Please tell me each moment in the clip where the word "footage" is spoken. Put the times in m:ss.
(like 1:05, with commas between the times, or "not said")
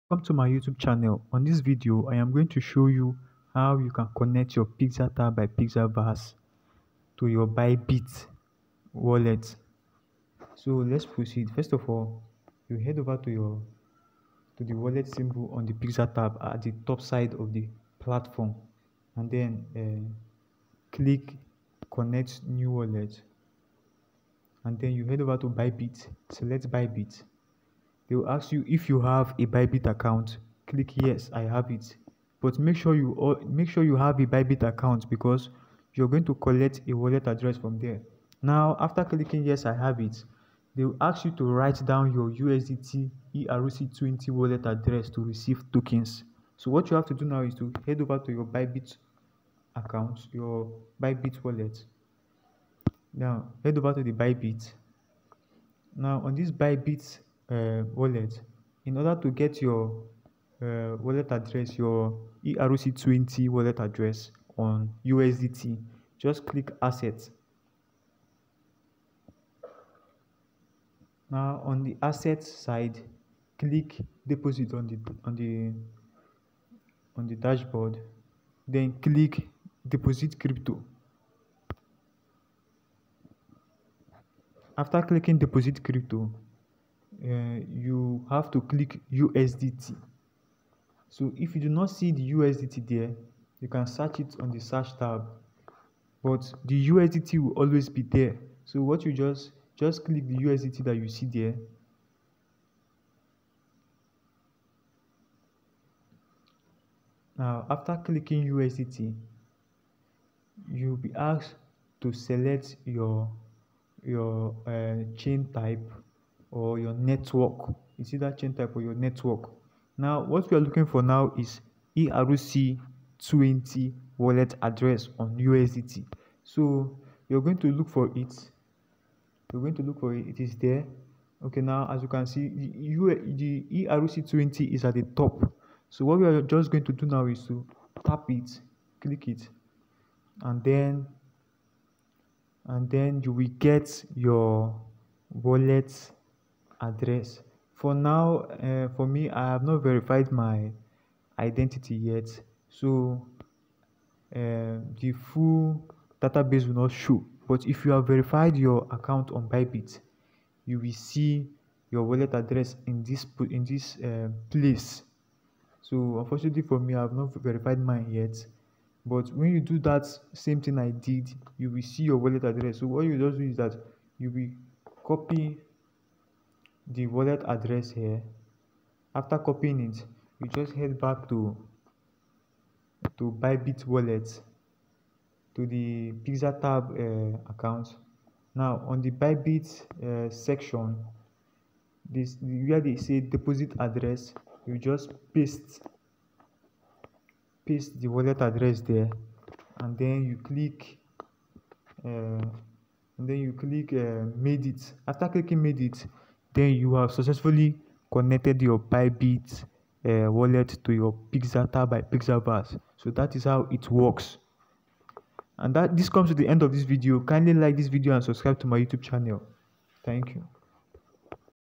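not said.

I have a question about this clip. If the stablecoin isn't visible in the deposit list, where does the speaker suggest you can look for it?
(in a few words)
The search tab.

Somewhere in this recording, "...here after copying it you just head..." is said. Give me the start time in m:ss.
2:57.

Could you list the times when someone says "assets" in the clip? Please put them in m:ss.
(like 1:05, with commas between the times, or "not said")
1:06, 1:12.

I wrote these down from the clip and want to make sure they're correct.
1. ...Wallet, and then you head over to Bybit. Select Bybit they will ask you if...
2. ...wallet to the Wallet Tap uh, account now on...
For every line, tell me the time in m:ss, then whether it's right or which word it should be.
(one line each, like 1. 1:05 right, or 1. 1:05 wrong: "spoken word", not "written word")
1. 0:22 right
2. 3:03 wrong: "Pixel", not "Wallet".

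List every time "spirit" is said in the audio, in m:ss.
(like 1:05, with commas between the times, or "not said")
not said.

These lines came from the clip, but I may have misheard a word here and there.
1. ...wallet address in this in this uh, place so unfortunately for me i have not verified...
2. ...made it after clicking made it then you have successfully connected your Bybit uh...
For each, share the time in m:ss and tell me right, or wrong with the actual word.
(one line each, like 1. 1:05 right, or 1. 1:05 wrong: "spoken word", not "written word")
1. 2:42 right
2. 3:24 right.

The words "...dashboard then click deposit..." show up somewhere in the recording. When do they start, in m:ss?
1:17.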